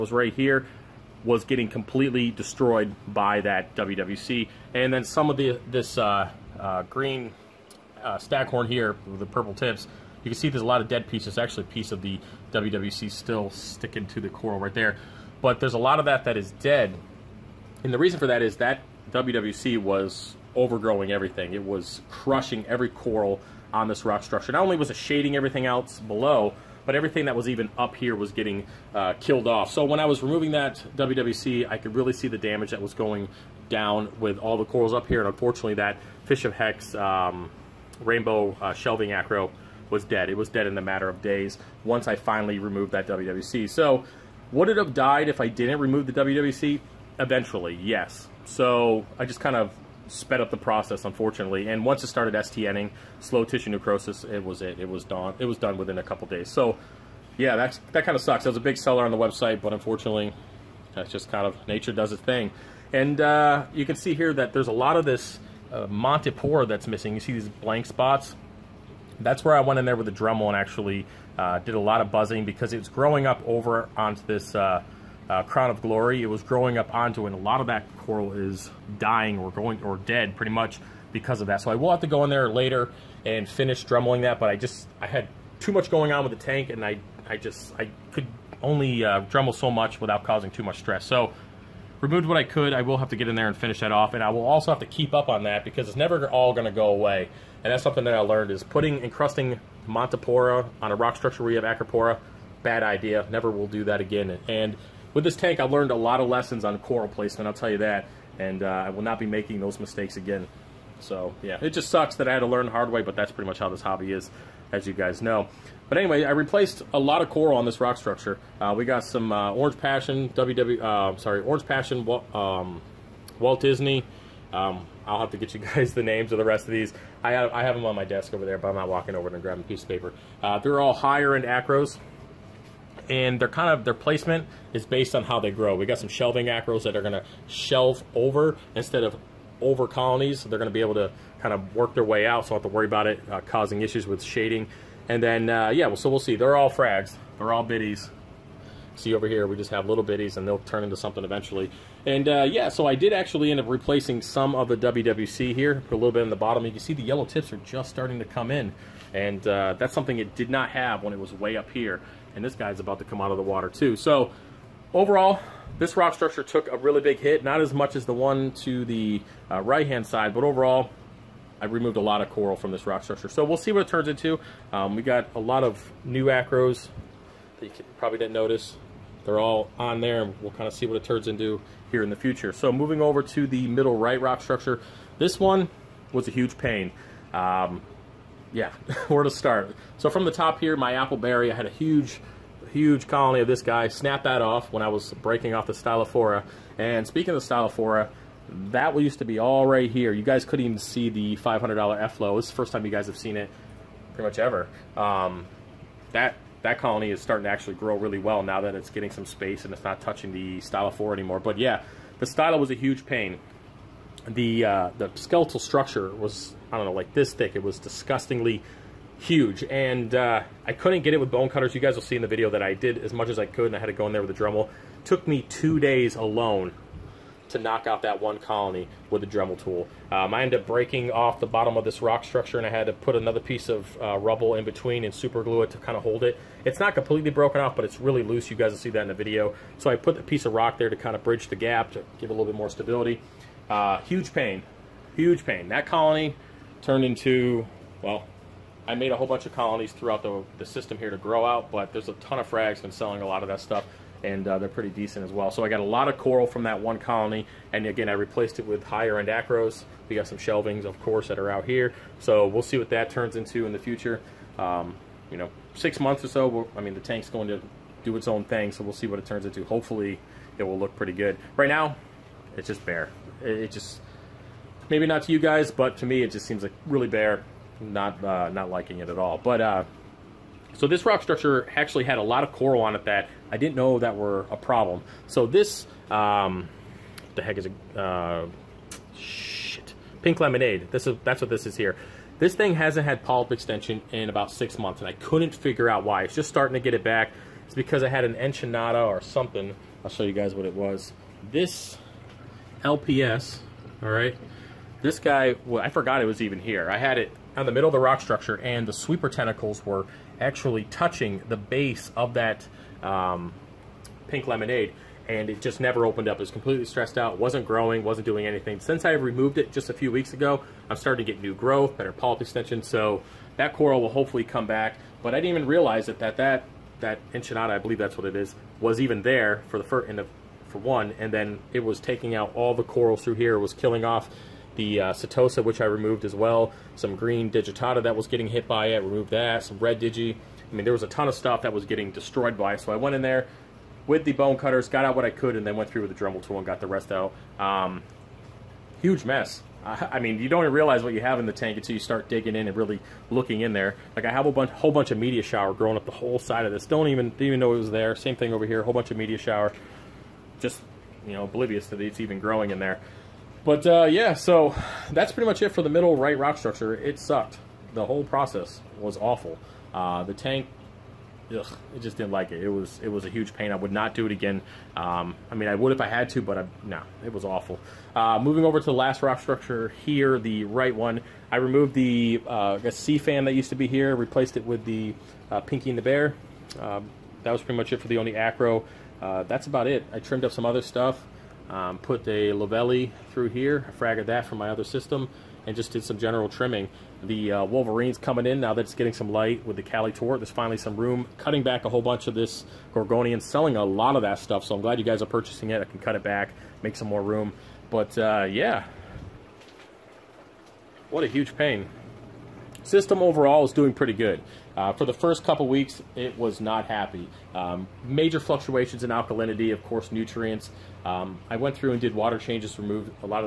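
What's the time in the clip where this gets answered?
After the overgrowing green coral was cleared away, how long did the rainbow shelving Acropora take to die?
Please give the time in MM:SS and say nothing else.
00:55.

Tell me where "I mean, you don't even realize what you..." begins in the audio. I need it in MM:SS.
05:49.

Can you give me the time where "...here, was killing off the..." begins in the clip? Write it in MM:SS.
05:33.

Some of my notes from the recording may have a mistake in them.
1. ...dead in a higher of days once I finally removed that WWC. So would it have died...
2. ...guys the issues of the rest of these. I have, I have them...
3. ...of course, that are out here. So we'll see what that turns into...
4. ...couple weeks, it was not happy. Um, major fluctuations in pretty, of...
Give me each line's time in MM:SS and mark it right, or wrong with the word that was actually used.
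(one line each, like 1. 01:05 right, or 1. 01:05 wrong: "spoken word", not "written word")
1. 00:40 wrong: "matter", not "higher"
2. 02:05 wrong: "names", not "issues"
3. 04:20 right
4. 06:55 wrong: "alkalinity", not "pretty".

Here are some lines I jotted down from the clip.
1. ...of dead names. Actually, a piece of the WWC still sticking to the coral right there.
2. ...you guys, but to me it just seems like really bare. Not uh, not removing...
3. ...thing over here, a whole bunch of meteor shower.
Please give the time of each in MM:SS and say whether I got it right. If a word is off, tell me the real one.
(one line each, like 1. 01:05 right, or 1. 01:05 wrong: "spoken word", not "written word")
1. 00:10 wrong: "pieces", not "names"
2. 04:35 wrong: "liking", not "removing"
3. 05:58 right.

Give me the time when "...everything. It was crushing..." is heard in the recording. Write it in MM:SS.
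00:21.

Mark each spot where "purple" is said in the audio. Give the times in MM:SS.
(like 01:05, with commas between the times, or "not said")
00:09.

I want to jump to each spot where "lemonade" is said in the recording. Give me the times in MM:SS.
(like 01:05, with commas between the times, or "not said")
04:50, 05:14.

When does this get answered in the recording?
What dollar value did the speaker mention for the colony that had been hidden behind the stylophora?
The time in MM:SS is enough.
03:21.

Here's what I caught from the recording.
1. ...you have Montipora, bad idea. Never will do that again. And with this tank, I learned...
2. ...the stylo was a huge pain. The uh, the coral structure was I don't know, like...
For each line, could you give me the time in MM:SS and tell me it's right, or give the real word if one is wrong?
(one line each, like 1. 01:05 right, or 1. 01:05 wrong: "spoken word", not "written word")
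1. 01:41 wrong: "Acropora", not "Montipora"
2. 03:32 wrong: "skeletal", not "coral".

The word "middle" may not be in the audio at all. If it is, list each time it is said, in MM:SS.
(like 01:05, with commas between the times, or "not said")
03:03, 05:07, 06:05.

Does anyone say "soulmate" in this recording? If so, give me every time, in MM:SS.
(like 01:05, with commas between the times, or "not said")
not said.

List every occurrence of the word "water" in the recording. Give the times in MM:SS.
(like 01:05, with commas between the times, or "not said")
02:43, 07:02.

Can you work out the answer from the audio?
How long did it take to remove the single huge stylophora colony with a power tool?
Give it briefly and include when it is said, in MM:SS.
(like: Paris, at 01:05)
Two days, at 03:45.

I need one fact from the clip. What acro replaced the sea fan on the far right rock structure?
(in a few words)
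Pinky and the Bear.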